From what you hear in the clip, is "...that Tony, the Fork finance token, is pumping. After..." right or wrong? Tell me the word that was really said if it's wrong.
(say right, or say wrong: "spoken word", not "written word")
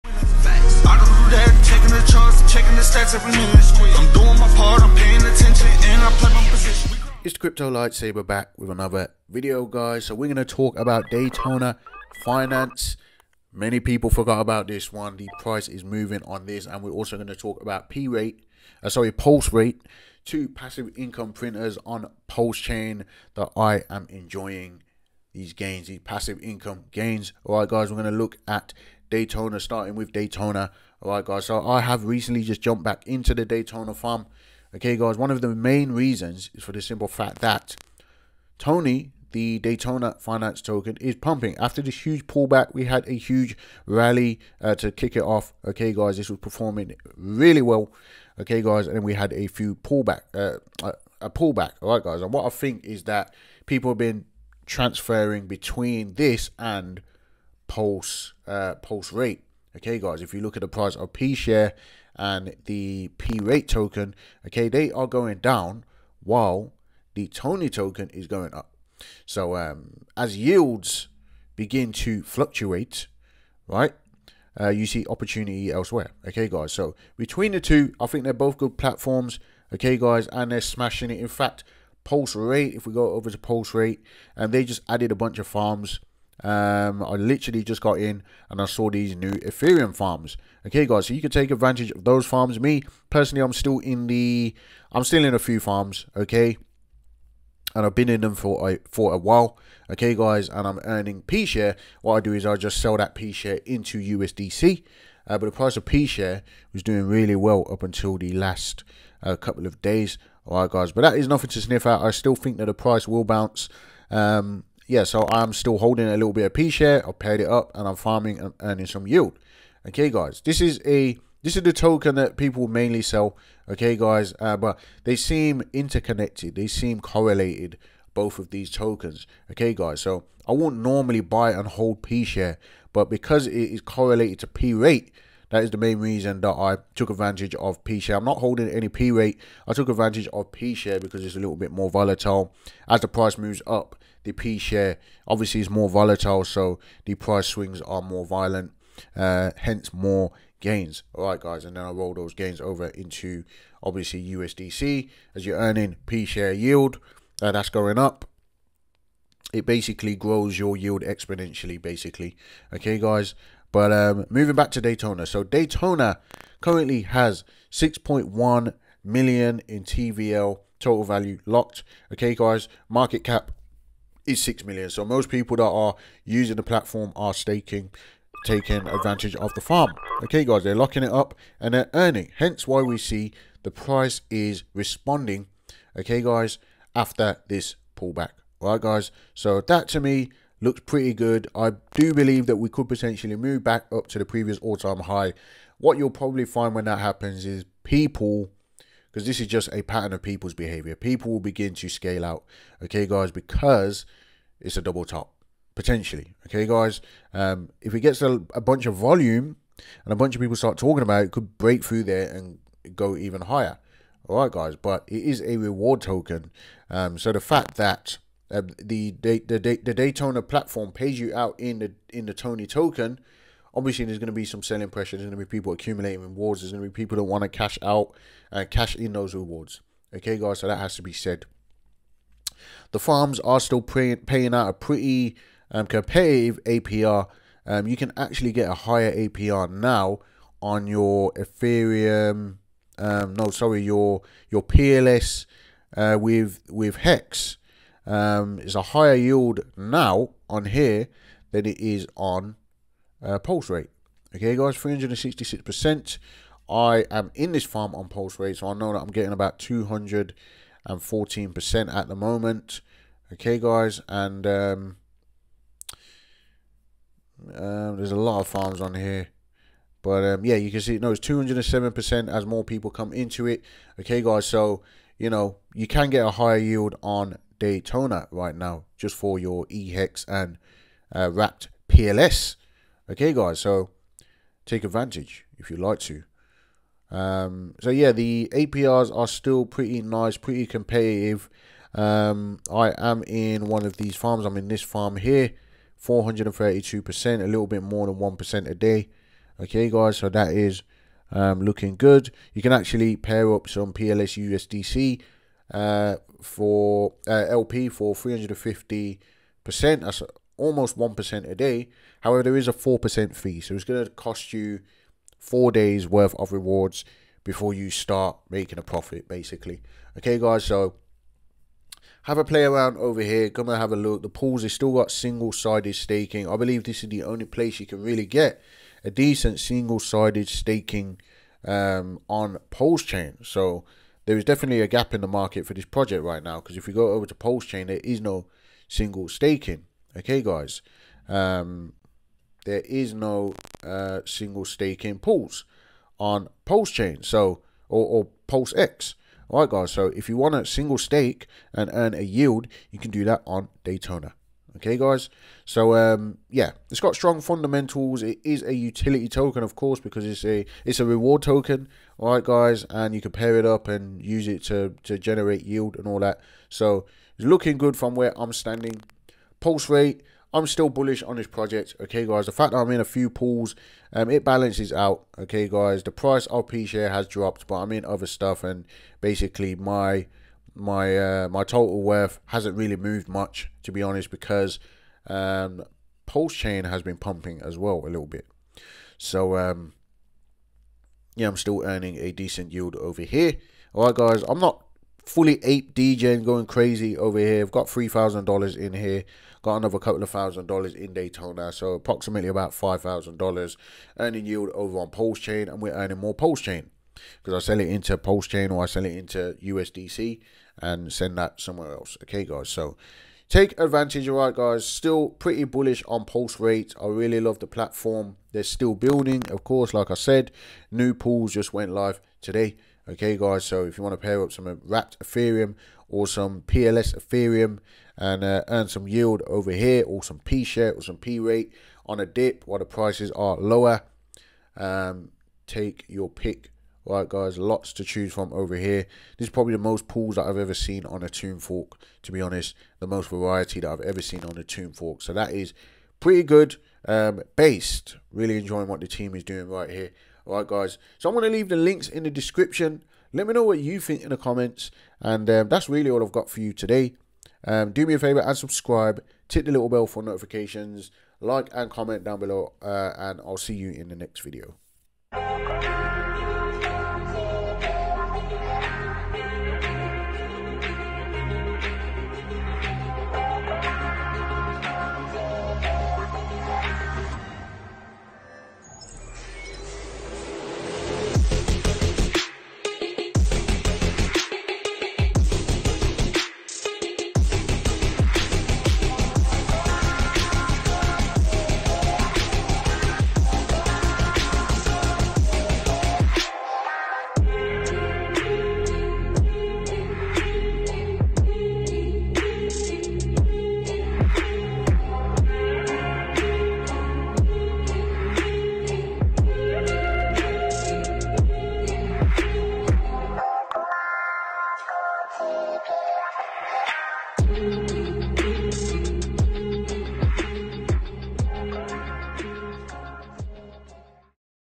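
wrong: "Daytona", not "Fork".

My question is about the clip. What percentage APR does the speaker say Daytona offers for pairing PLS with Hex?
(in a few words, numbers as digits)
366%.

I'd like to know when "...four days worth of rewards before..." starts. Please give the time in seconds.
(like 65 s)
315 s.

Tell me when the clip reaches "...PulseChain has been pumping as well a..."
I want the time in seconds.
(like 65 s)
386 s.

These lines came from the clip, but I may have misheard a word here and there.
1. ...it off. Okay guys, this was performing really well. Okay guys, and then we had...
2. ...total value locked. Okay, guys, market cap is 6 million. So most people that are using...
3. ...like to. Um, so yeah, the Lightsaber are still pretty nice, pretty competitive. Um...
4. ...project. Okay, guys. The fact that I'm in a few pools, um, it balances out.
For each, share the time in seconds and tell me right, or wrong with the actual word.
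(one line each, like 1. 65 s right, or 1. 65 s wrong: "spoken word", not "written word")
1. 45 s right
2. 170 s right
3. 285 s wrong: "APRs", not "Lightsaber"
4. 371 s right.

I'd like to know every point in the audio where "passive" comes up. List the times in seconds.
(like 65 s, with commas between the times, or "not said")
20 s, 25 s.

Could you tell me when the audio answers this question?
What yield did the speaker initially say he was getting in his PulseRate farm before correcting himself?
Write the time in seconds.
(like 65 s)
259 s.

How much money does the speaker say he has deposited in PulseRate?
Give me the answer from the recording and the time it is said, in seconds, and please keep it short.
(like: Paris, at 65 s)
$3,000, at 397 s.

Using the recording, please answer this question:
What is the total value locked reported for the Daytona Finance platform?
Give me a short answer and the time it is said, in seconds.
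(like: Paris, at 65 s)
6.1 million, at 167 s.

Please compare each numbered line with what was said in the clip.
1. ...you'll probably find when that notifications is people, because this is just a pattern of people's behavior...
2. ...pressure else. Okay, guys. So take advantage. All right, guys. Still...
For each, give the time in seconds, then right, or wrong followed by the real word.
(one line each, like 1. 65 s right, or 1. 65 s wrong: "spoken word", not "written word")
1. 195 s wrong: "happens", not "notifications"
2. 411 s wrong: "somewhere", not "pressure".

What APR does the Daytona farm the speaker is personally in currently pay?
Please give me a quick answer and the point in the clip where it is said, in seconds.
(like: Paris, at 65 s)
432%, at 296 s.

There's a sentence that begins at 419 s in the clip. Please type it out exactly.
Of course, like I said, new pools just went live today.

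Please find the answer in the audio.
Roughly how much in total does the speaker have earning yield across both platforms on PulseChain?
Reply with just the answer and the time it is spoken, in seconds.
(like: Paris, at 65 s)
$5,000, at 402 s.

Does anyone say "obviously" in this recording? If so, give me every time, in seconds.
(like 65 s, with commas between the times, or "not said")
145 s, 153 s, 223 s.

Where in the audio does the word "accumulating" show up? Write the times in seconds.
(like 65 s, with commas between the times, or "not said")
225 s.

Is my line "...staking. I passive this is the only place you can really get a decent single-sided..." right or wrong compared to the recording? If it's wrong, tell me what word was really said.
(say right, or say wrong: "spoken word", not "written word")
wrong: "believe", not "passive".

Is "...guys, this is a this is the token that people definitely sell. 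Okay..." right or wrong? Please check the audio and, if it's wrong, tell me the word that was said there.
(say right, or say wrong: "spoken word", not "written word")
wrong: "mainly", not "definitely".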